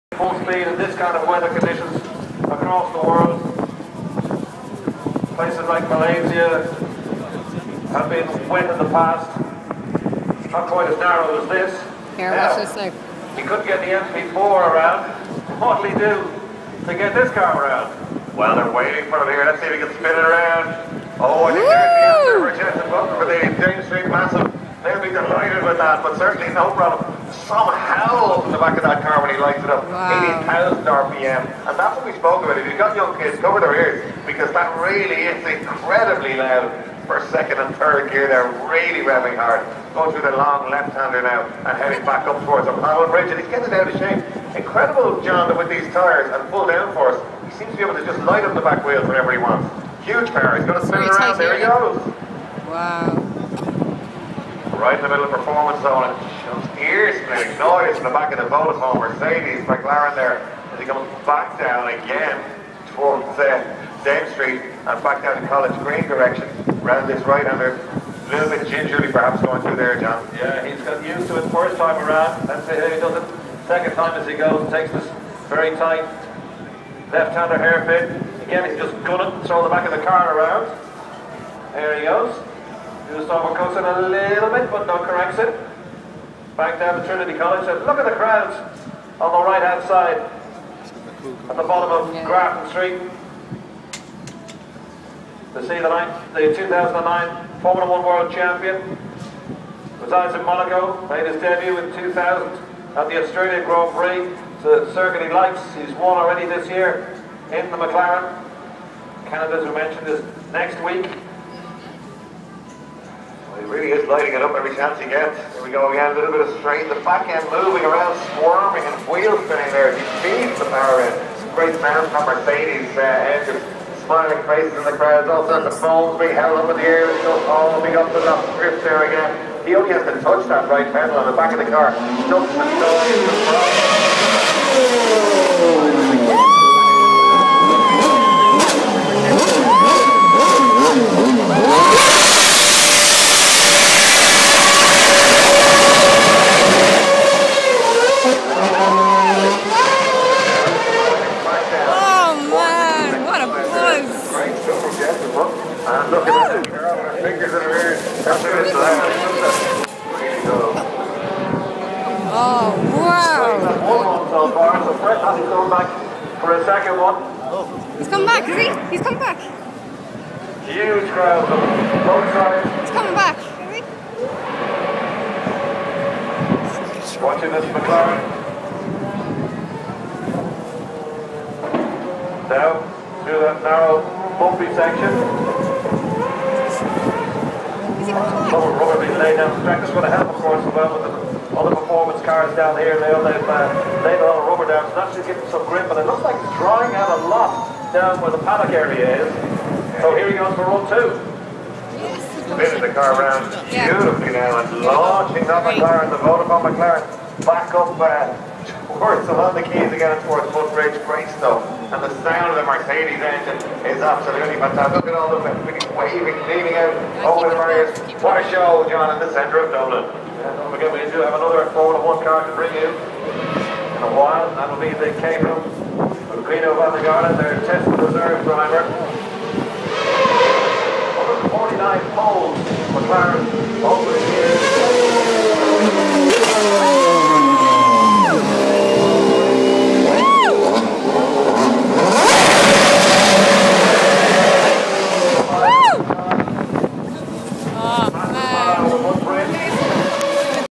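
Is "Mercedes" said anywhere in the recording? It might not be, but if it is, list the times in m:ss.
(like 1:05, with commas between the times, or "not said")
0:58, 2:02, 3:32.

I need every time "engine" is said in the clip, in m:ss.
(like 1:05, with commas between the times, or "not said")
2:03, 3:33.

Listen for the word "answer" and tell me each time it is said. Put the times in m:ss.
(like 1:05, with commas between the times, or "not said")
0:22.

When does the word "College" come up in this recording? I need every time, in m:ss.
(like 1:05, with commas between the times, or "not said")
1:05, 1:27.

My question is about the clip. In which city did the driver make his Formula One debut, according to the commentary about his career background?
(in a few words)
Australian Grand Prix.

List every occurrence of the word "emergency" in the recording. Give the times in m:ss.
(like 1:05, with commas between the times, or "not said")
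not said.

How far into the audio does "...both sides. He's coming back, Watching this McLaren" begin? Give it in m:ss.
2:52.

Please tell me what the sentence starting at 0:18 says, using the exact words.
Well, they're waiting for him here.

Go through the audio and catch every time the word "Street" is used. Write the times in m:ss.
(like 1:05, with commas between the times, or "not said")
0:23, 1:04, 1:32.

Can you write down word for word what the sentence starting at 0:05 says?
Places like Malaysia have been wet in the past, not quite as narrow as this.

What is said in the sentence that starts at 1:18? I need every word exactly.
Again, he's just gonna throw the back of the car around.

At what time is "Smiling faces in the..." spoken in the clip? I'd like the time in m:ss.
2:04.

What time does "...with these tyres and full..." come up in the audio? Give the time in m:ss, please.
0:45.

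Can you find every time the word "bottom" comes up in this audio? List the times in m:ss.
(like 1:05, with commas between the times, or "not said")
1:31.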